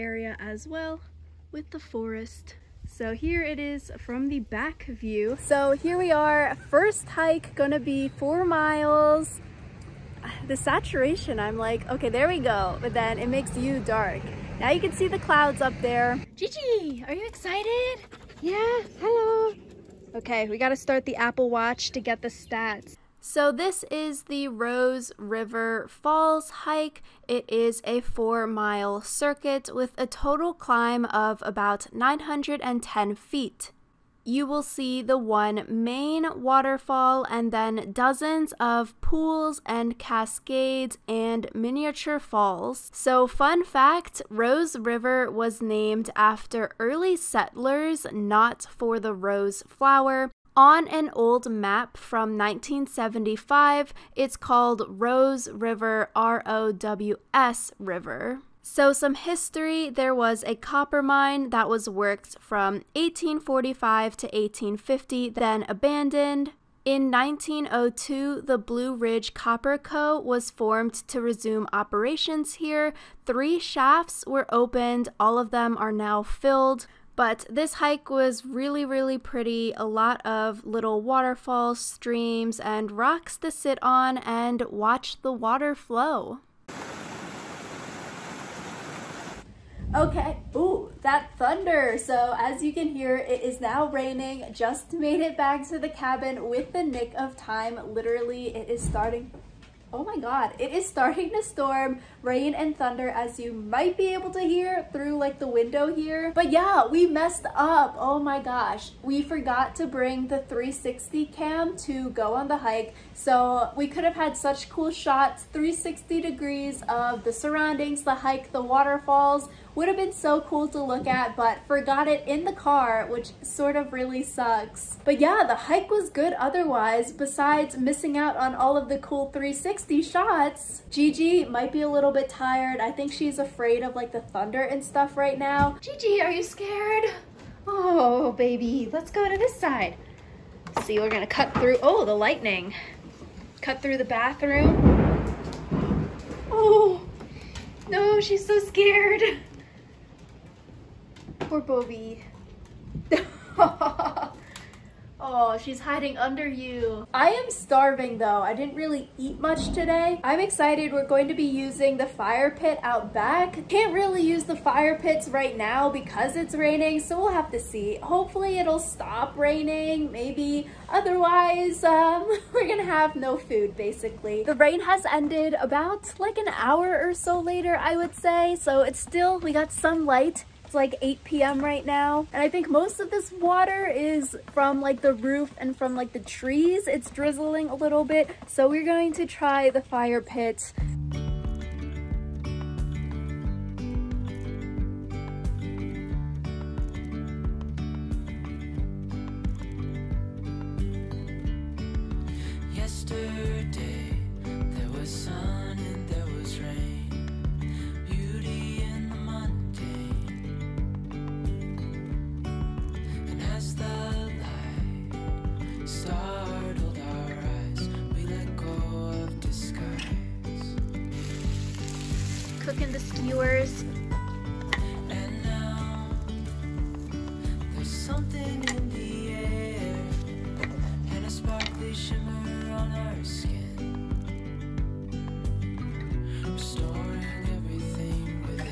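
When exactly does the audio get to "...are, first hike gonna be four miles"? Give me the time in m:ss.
0:06.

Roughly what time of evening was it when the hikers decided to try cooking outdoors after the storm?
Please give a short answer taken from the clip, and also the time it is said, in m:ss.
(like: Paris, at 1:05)
8 p.m., at 3:01.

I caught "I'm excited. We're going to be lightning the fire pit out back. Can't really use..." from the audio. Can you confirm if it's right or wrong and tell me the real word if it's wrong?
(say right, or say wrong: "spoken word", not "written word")
wrong: "using", not "lightning".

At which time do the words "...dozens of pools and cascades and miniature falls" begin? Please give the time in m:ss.
0:37.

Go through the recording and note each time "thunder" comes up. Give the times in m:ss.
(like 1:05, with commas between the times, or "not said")
1:31, 1:42, 2:14.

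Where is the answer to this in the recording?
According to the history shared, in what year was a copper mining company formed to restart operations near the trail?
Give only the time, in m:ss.
1:07.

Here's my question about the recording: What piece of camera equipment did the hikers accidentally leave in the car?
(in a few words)
360 cam.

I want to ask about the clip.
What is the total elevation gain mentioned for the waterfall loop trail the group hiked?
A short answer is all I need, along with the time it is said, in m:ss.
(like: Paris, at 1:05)
910 feet, at 0:31.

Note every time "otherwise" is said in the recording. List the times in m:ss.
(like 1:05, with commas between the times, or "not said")
2:06, 2:50.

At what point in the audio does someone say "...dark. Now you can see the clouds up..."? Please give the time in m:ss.
0:13.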